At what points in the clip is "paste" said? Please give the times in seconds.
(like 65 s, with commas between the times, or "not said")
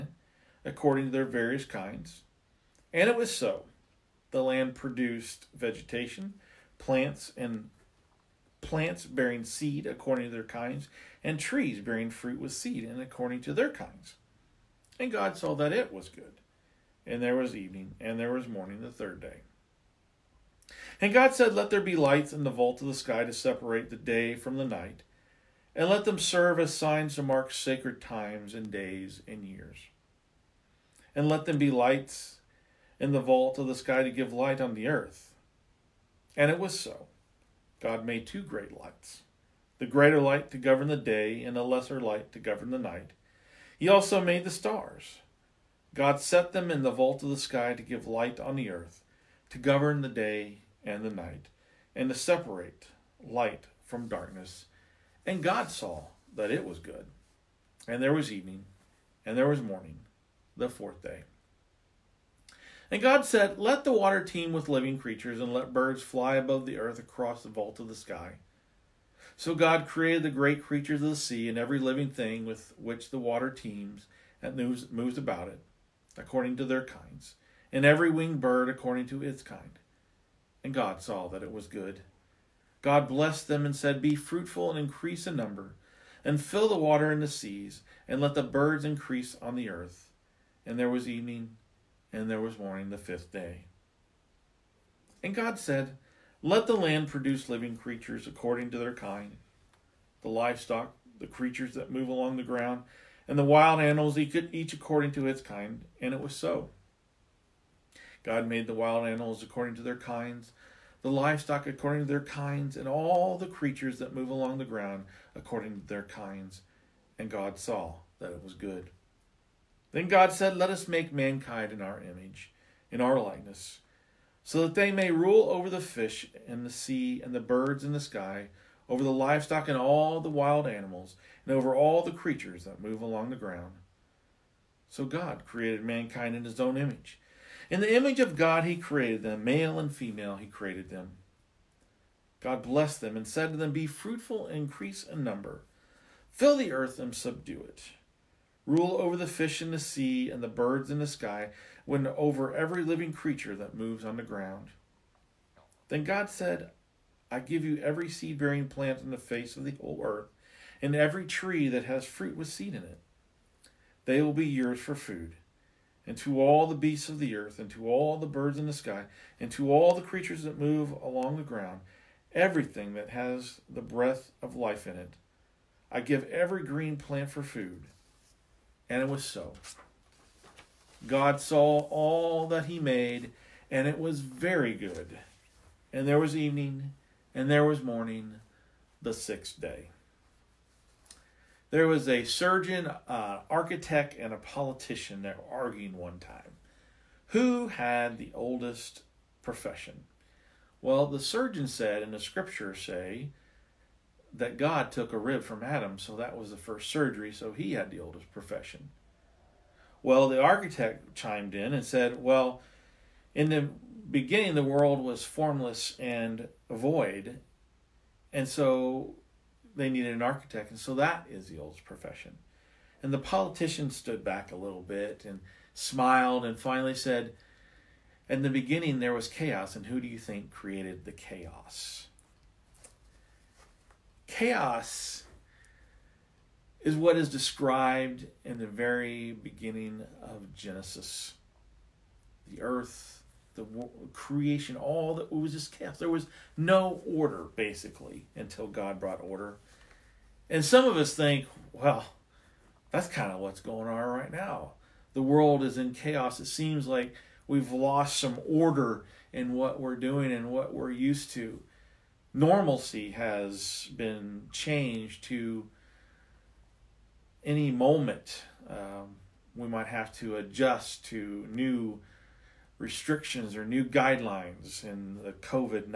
not said.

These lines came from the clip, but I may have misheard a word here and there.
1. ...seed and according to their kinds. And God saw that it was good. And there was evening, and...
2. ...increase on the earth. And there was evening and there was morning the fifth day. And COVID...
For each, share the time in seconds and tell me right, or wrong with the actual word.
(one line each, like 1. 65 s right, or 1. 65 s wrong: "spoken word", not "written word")
1. 12 s right
2. 88 s wrong: "God", not "COVID".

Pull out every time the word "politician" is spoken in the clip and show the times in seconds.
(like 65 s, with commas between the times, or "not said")
194 s, 223 s.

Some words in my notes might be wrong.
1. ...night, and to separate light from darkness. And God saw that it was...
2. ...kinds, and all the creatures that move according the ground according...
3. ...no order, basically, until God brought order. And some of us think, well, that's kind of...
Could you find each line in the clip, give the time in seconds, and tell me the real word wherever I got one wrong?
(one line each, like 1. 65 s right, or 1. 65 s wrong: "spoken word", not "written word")
1. 51 s right
2. 112 s wrong: "along", not "according"
3. 246 s right.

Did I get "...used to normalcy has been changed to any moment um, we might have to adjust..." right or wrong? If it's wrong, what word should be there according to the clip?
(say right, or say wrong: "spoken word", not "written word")
right.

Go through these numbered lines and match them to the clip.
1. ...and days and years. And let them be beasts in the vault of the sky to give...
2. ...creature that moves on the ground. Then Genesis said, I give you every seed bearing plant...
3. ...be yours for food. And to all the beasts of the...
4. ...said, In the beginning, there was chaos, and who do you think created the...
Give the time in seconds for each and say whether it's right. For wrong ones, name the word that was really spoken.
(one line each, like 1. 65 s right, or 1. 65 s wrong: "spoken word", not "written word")
1. 28 s wrong: "lights", not "beasts"
2. 153 s wrong: "God", not "Genesis"
3. 164 s right
4. 226 s right.